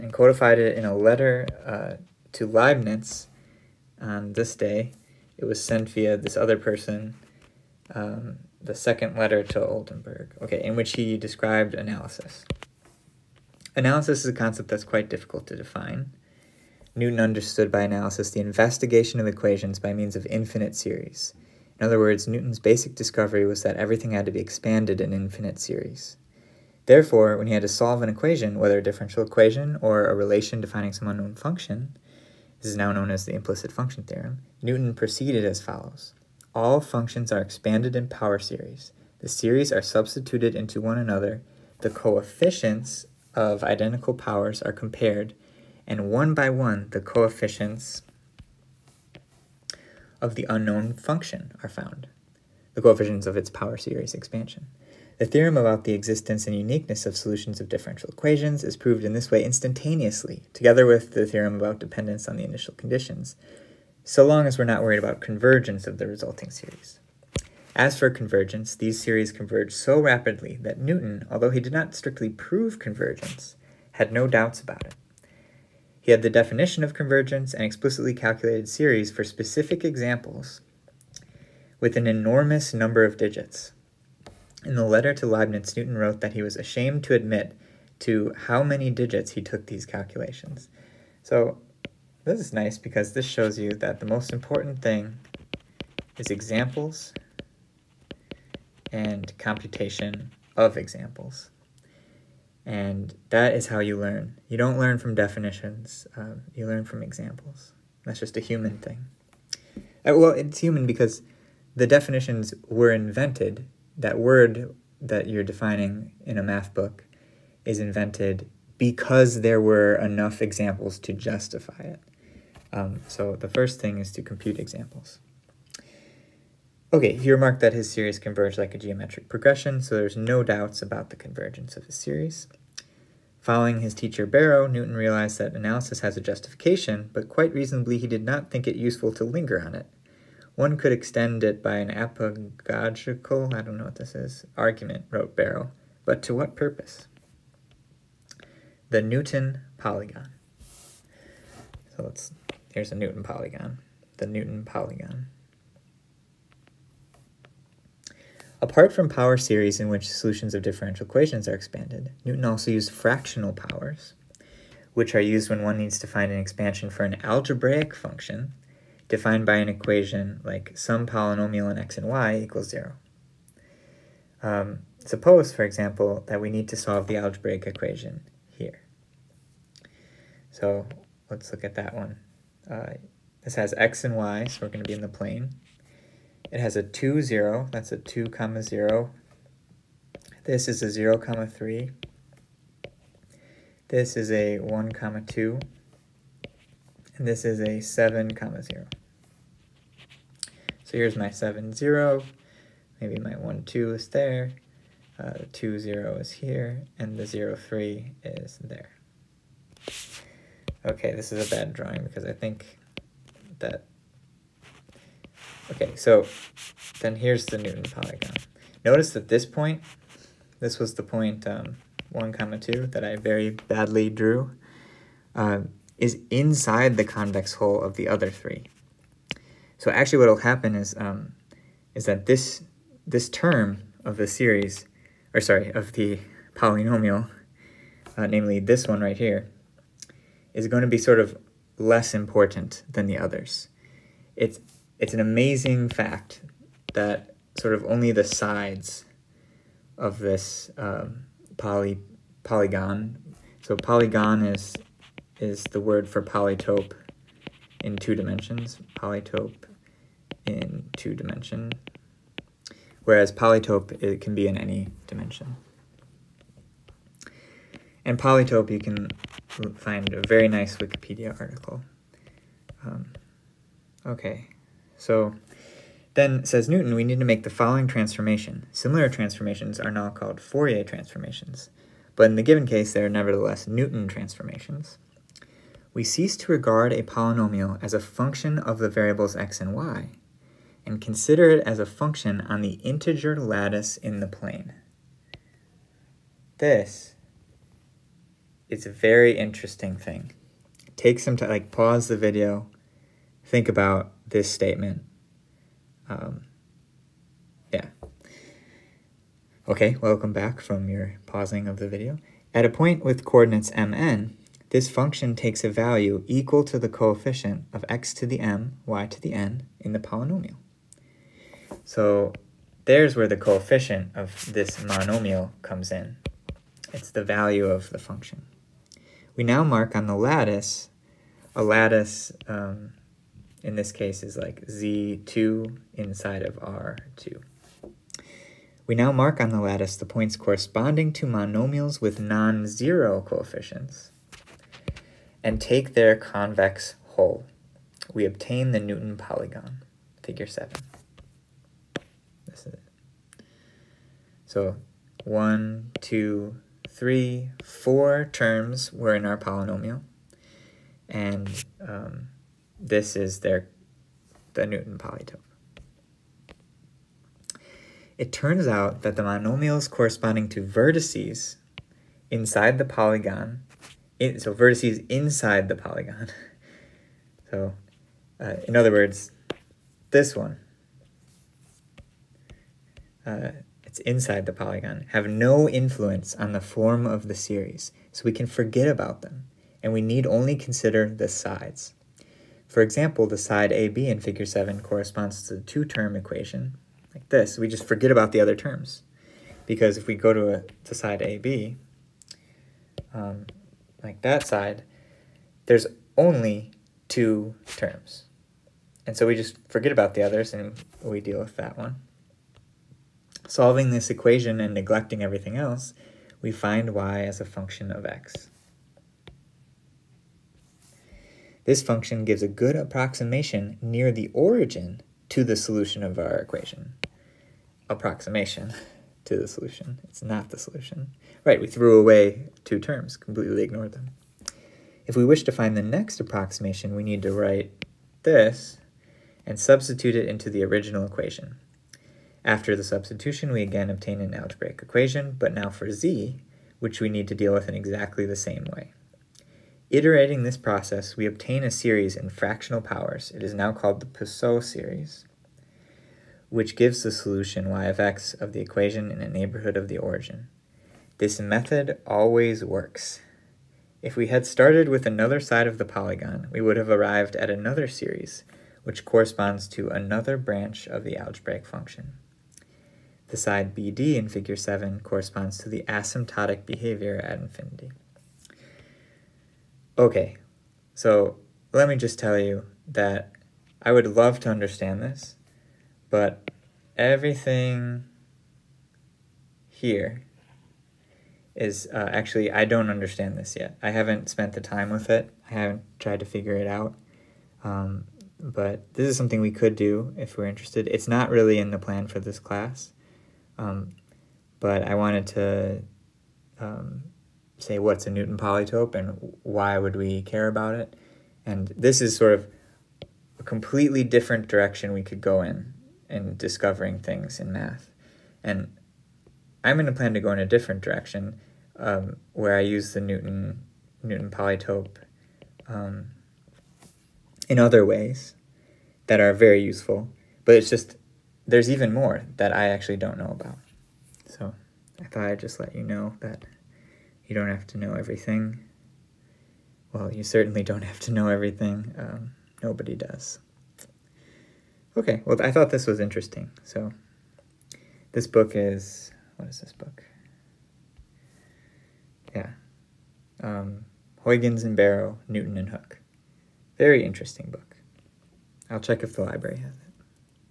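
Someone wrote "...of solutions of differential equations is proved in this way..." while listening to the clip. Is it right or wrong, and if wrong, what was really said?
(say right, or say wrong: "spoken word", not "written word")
right.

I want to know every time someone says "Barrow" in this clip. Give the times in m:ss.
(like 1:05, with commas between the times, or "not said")
2:14, 2:25, 9:14.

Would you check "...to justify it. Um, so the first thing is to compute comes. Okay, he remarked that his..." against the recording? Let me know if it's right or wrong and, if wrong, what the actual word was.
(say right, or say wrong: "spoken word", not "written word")
wrong: "examples", not "comes".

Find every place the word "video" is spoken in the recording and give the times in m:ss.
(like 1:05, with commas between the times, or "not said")
5:02, 5:11.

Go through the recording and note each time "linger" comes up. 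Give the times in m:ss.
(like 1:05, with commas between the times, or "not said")
2:19.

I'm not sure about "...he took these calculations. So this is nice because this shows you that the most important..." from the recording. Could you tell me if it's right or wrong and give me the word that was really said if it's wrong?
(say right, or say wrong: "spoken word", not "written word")
right.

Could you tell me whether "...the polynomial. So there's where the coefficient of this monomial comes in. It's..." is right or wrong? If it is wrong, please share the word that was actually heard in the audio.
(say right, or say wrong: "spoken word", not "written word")
right.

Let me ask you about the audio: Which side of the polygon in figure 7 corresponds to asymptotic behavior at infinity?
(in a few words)
BD.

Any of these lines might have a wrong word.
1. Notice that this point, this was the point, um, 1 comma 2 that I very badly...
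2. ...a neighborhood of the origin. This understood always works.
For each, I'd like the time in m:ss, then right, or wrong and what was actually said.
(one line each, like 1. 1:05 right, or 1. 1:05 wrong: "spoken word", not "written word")
1. 3:38 right
2. 7:39 wrong: "method", not "understood".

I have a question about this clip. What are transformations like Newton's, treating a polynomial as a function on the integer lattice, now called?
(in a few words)
Fourier transformations.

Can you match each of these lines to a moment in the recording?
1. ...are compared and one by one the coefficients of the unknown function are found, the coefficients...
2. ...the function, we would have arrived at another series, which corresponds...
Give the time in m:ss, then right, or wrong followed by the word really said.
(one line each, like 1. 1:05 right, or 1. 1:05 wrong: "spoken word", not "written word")
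1. 0:44 right
2. 7:45 wrong: "polygon", not "function".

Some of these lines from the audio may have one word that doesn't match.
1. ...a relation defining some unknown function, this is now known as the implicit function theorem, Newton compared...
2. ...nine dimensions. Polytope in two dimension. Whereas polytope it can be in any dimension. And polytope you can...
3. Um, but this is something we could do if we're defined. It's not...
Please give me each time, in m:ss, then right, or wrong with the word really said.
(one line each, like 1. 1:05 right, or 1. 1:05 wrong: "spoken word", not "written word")
1. 0:30 wrong: "proceeded", not "compared"
2. 4:17 wrong: "two", not "nine"
3. 8:17 wrong: "interested", not "defined".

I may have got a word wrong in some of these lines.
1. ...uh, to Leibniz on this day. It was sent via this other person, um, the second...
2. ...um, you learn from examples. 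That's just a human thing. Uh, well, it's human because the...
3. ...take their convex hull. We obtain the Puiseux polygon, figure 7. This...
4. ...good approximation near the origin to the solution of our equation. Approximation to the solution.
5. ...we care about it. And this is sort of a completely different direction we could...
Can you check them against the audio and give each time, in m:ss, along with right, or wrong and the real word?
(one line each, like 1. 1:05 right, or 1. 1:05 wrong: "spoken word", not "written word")
1. 0:01 right
2. 1:46 right
3. 5:45 wrong: "Newton", not "Puiseux"
4. 7:02 right
5. 8:29 right.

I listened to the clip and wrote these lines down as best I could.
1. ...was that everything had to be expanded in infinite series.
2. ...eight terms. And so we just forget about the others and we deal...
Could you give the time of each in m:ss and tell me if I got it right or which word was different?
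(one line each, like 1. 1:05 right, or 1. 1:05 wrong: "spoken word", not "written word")
1. 0:23 right
2. 6:47 wrong: "two", not "eight".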